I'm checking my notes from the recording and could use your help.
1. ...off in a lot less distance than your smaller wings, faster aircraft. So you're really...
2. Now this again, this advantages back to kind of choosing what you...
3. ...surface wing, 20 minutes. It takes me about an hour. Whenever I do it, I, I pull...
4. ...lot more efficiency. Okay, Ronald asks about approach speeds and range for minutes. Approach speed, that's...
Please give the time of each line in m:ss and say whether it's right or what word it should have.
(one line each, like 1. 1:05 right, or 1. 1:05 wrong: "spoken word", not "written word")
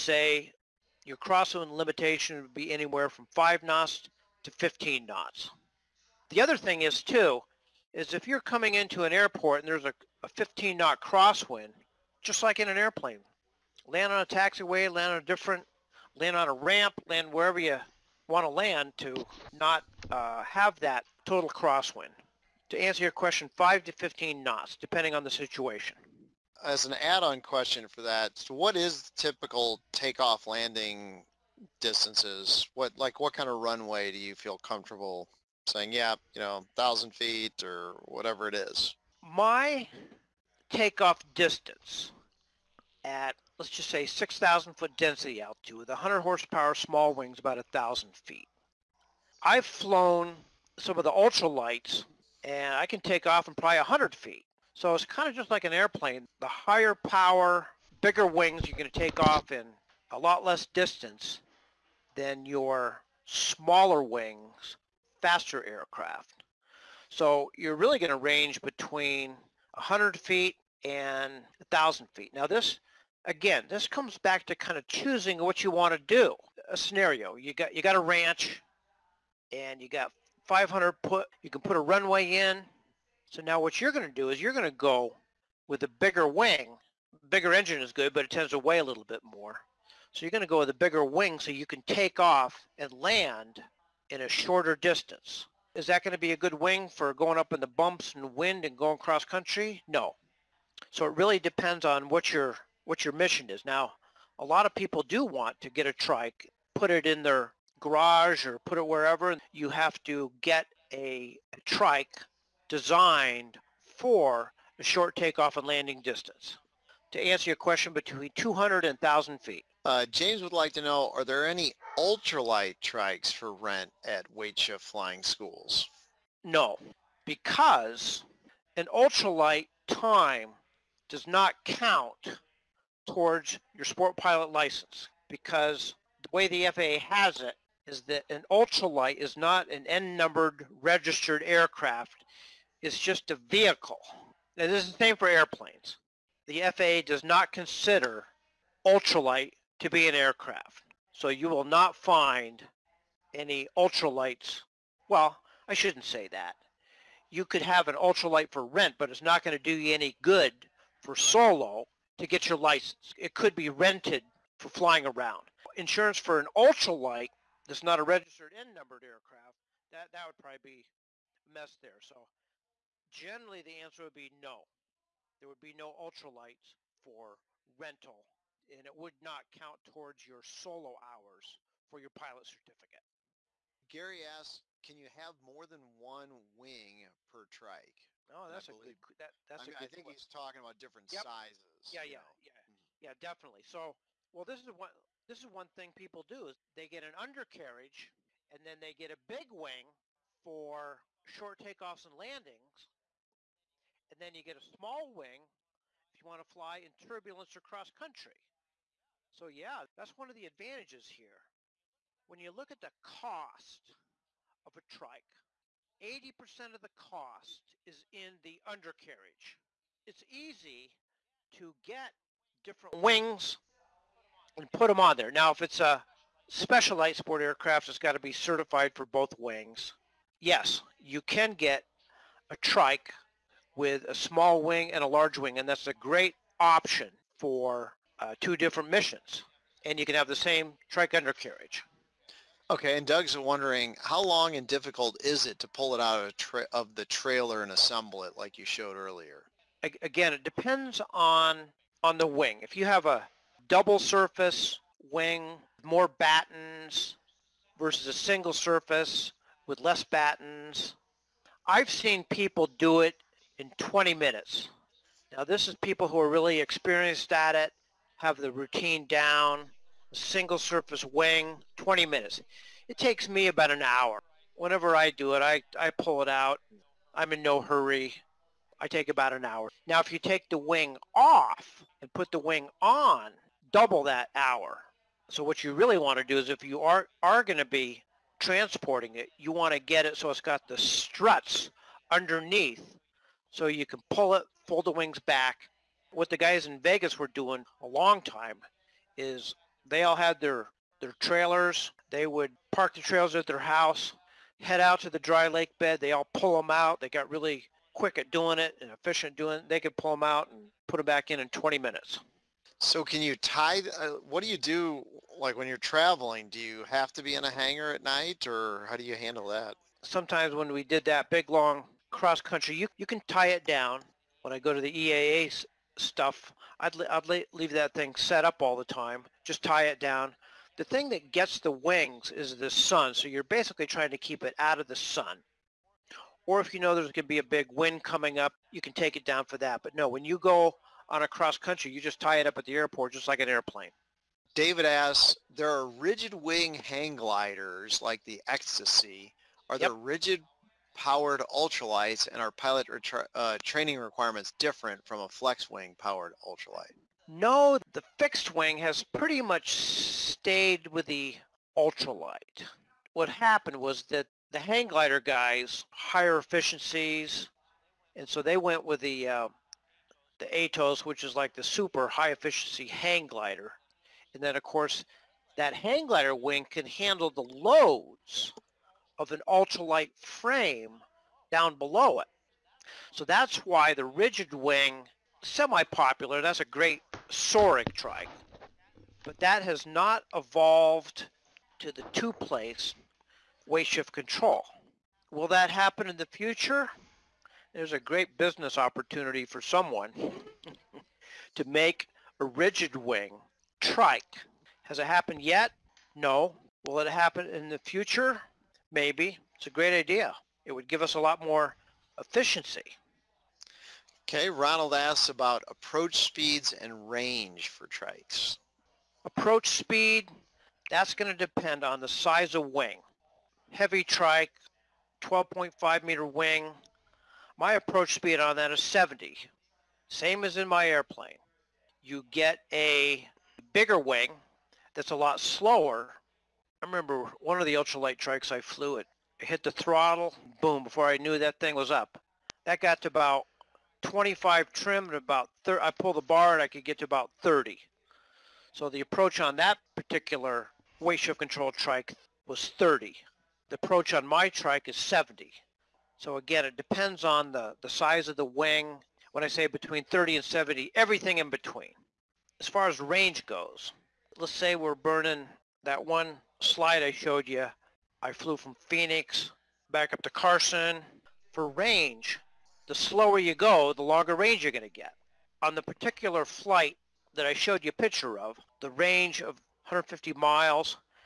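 1. 0:59 right
2. 1:12 wrong: "comes", not "advantages"
3. 4:30 right
4. 6:51 wrong: "trikes", not "minutes".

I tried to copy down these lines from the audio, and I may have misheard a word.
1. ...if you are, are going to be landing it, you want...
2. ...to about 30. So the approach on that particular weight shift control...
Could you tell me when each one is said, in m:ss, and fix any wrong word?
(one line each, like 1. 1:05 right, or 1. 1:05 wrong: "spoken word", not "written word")
1. 4:46 wrong: "transporting", not "landing"
2. 7:26 right.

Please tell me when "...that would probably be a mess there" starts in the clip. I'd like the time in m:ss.
2:50.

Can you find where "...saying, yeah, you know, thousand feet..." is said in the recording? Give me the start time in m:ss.
0:35.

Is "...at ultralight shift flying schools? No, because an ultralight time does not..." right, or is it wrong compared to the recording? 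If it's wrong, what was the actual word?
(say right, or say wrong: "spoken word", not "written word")
wrong: "weight", not "ultralight".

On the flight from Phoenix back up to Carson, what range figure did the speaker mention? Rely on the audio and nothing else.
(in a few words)
150 miles.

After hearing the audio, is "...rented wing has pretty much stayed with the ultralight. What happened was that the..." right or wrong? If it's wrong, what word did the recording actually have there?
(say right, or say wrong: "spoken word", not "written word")
wrong: "fixed", not "rented".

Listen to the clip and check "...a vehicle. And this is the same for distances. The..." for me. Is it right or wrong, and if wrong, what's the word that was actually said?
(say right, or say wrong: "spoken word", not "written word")
wrong: "airplanes", not "distances".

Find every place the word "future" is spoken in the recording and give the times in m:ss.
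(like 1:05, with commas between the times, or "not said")
6:36, 6:47.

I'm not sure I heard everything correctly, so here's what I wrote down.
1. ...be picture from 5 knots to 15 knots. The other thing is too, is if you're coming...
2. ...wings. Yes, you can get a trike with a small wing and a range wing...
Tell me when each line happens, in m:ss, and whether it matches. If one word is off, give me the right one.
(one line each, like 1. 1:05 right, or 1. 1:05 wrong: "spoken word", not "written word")
1. 0:02 wrong: "anywhere", not "picture"
2. 3:49 wrong: "large", not "range".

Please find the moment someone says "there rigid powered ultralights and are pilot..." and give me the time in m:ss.
5:49.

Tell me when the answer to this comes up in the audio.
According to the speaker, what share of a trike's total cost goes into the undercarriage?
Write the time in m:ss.
3:36.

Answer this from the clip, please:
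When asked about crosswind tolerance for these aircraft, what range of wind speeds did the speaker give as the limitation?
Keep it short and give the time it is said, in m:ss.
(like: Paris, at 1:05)
5 to 15 knots, at 0:23.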